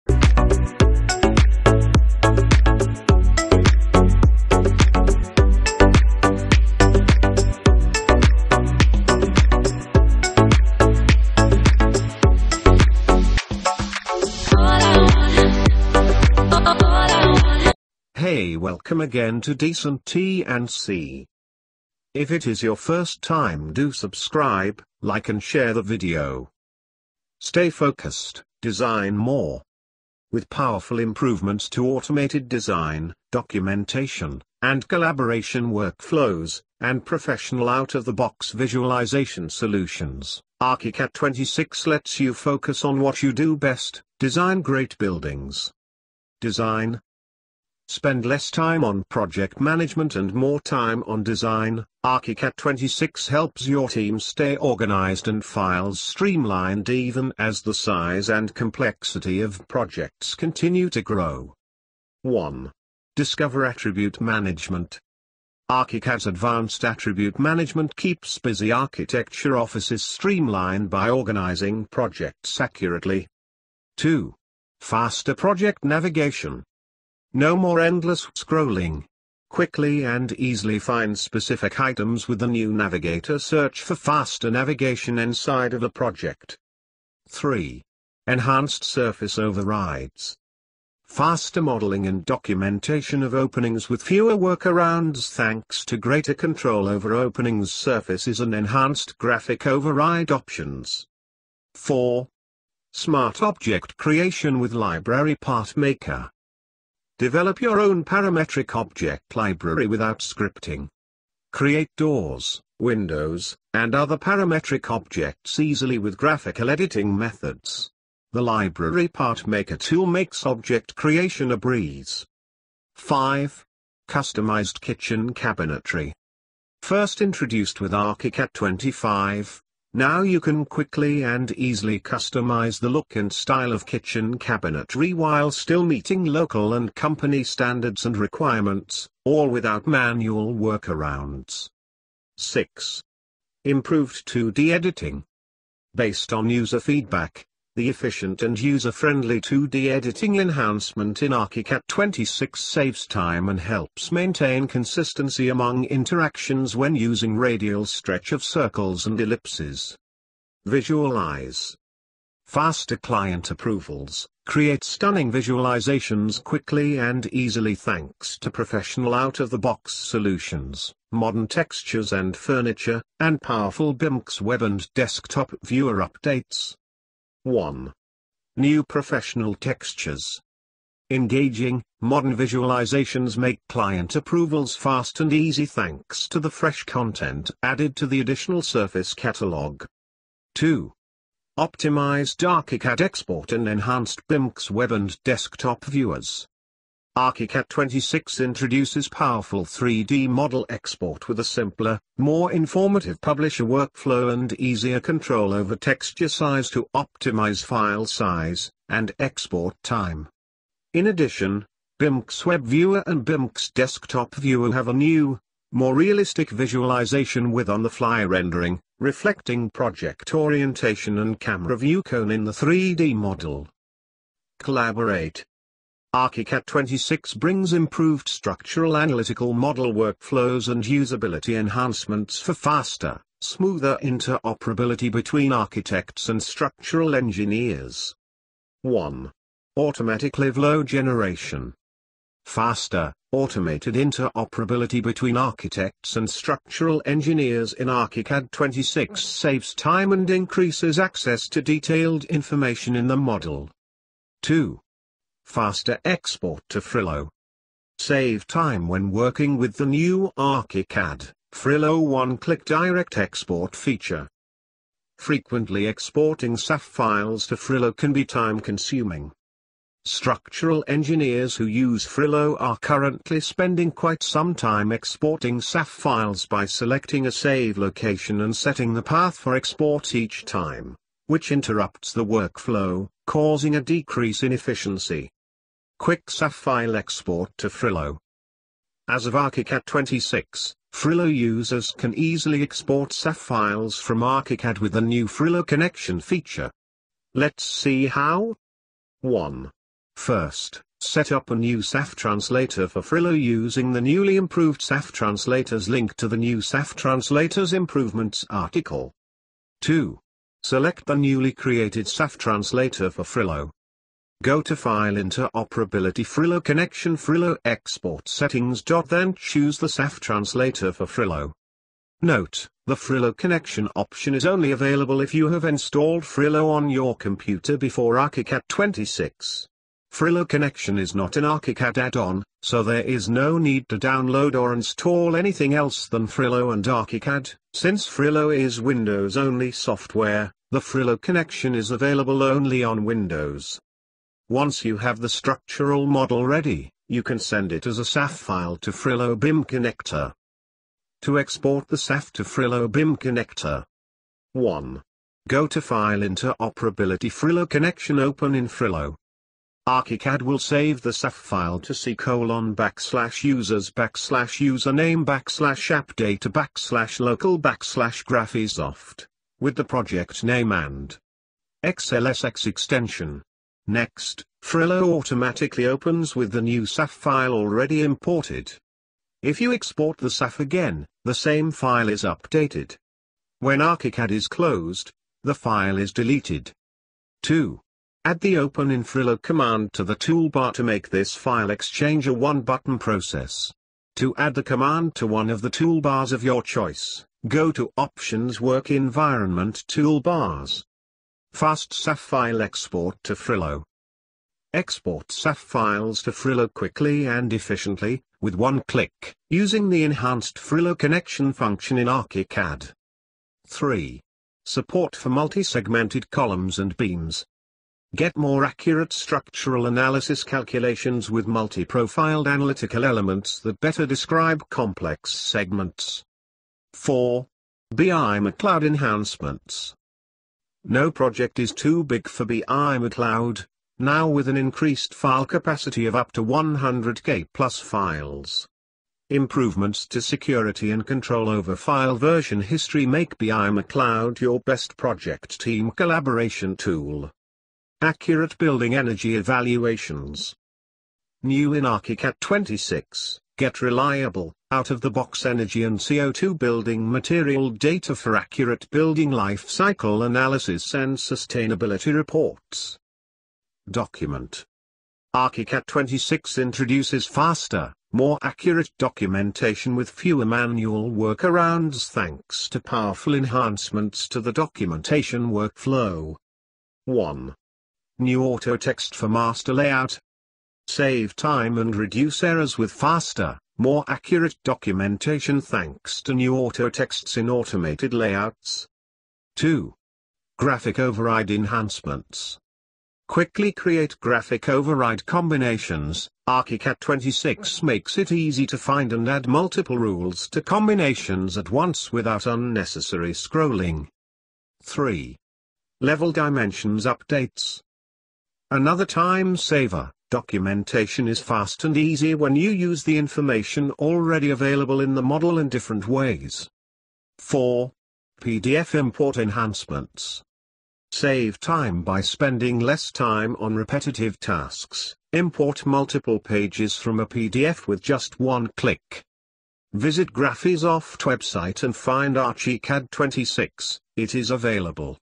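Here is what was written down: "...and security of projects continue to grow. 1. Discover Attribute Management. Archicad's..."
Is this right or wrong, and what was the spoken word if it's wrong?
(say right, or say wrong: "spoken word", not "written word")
wrong: "complexity", not "security".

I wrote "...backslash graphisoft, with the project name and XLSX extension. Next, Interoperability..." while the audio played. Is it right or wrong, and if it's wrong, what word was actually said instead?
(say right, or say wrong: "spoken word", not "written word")
wrong: "Frilo", not "Interoperability".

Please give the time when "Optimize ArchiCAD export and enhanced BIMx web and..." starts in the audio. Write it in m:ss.
3:11.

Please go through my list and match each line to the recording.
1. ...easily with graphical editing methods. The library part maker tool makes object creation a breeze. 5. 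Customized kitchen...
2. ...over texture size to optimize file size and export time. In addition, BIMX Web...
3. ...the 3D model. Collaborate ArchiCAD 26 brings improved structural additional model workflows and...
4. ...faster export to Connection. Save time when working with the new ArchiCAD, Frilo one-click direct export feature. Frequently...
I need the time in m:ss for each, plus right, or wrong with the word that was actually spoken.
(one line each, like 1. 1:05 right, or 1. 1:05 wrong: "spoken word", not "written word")
1. 1:55 right
2. 3:25 right
3. 3:42 wrong: "analytical", not "additional"
4. 4:15 wrong: "Frilo", not "Connection".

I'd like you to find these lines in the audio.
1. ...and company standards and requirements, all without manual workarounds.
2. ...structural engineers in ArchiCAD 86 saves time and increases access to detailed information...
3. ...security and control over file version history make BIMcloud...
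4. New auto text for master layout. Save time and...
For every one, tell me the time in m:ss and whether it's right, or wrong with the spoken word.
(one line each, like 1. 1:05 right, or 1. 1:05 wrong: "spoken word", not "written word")
1. 2:16 right
2. 4:06 wrong: "26", not "86"
3. 7:20 right
4. 7:58 right.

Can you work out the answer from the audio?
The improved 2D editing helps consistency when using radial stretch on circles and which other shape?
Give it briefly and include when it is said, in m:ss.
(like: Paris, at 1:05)
ellipses, at 2:39.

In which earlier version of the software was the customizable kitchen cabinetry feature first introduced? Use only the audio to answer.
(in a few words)
ArchiCAD 25.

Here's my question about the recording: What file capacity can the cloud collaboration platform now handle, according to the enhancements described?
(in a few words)
100k plus files.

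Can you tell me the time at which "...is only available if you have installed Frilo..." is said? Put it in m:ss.
5:24.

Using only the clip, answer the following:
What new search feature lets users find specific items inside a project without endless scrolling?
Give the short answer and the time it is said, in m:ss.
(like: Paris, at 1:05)
navigator search, at 1:22.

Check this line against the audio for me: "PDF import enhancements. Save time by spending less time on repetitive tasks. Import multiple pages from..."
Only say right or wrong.
right.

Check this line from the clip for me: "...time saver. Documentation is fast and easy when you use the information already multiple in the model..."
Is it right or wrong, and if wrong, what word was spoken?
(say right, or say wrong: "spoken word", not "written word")
wrong: "available", not "multiple".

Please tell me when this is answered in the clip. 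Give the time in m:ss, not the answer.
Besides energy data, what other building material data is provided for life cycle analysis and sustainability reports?
7:35.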